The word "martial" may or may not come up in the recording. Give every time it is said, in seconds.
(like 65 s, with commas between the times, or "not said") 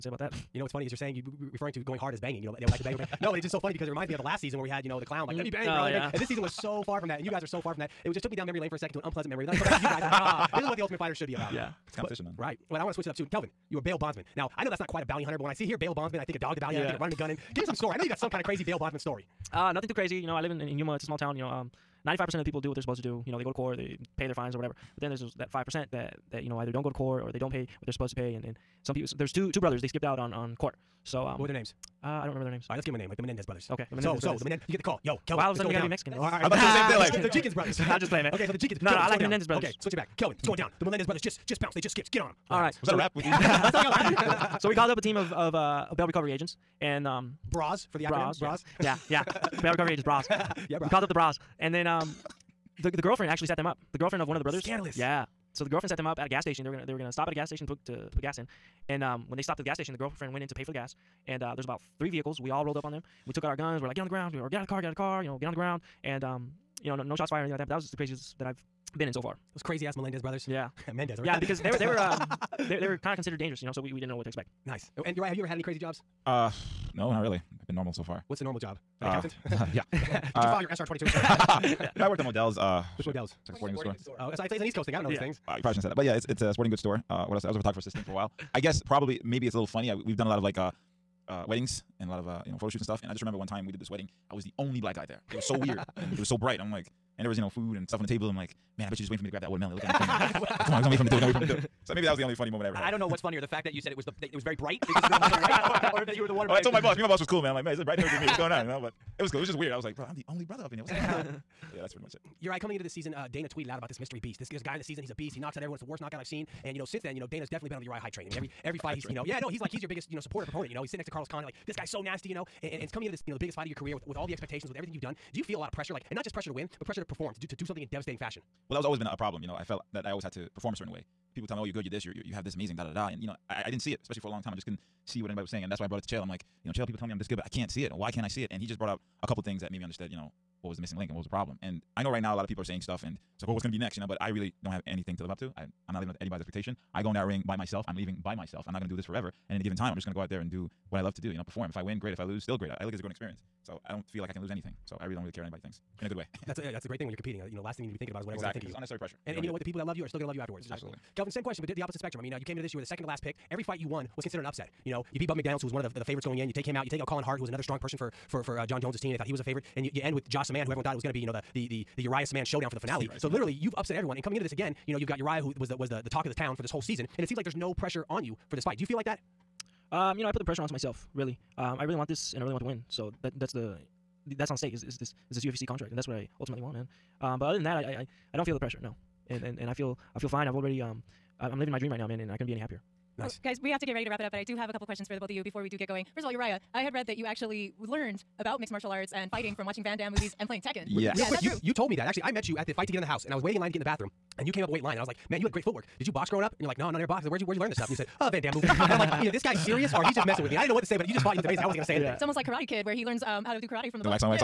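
198 s.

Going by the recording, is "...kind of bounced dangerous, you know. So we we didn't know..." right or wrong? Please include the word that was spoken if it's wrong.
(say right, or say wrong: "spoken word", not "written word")
wrong: "considered", not "bounced".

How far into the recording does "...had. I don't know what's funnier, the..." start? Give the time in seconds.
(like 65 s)
102 s.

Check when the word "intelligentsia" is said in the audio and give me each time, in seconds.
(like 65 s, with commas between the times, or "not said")
not said.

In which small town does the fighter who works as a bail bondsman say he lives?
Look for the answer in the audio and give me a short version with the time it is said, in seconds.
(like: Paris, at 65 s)
Yuma, at 20 s.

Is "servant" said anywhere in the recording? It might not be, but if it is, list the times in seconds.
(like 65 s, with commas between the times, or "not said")
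not said.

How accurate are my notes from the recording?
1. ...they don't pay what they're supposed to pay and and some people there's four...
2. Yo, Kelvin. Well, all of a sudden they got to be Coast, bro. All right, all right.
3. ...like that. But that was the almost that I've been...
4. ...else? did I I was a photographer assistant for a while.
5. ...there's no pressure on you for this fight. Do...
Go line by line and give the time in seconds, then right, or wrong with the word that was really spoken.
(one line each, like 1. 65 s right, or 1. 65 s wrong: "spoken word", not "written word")
1. 27 s wrong: "two", not "four"
2. 35 s wrong: "Mexican", not "Coast"
3. 67 s wrong: "craziest", not "almost"
4. 87 s right
5. 177 s right.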